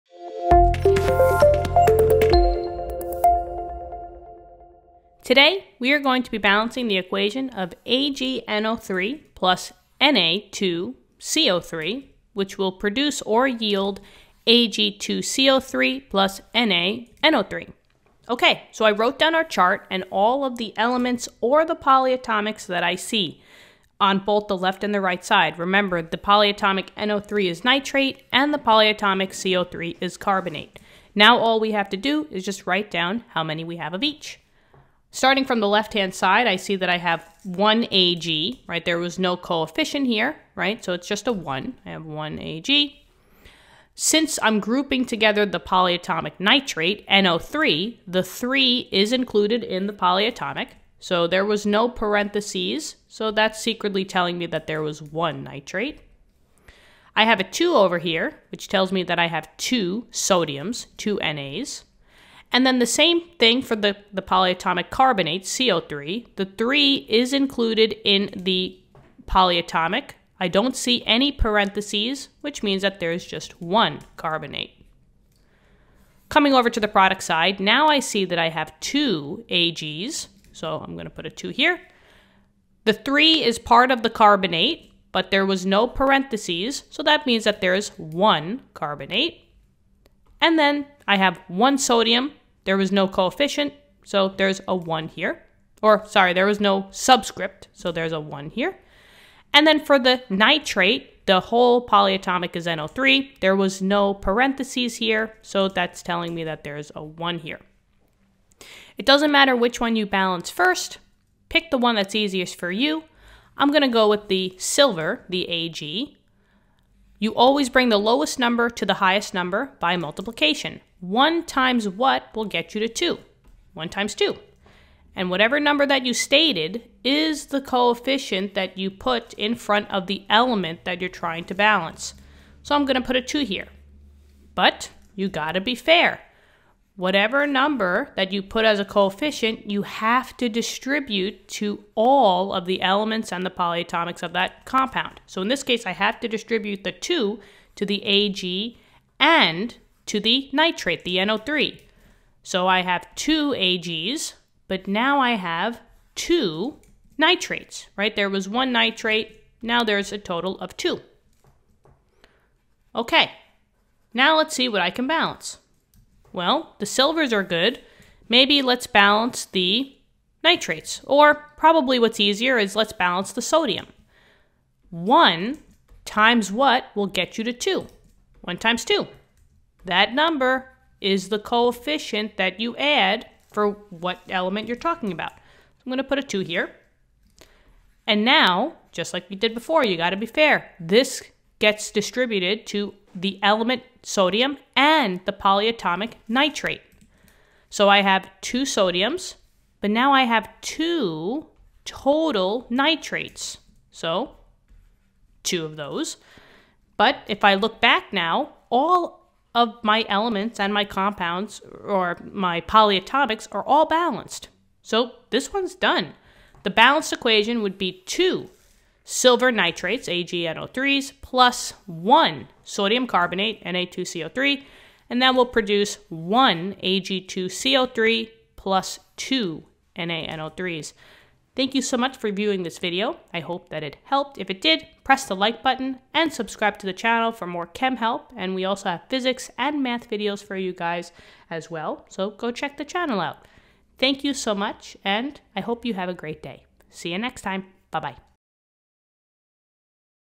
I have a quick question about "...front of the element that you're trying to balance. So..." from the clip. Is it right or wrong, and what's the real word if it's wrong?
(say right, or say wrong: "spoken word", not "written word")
right.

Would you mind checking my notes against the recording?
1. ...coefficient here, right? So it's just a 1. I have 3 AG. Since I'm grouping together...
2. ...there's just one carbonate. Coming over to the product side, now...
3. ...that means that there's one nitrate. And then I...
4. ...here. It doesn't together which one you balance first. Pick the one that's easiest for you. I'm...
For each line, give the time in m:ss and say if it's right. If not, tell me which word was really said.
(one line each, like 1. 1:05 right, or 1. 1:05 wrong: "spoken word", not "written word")
1. 0:39 wrong: "1", not "3"
2. 1:12 right
3. 1:27 wrong: "carbonate", not "nitrate"
4. 1:47 wrong: "matter", not "together".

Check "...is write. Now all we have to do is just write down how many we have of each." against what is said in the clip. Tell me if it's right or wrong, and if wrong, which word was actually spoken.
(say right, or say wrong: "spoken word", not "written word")
wrong: "carbonate", not "write".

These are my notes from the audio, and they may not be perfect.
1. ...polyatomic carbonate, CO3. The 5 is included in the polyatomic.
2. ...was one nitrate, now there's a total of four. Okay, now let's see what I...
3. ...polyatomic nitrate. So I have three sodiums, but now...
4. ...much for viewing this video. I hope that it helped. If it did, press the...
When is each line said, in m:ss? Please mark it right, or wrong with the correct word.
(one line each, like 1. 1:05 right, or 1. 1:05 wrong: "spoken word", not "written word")
1. 1:04 wrong: "3", not "5"
2. 2:38 wrong: "two", not "four"
3. 3:15 wrong: "two", not "three"
4. 3:51 right.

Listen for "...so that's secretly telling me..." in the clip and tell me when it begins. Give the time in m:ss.
0:53.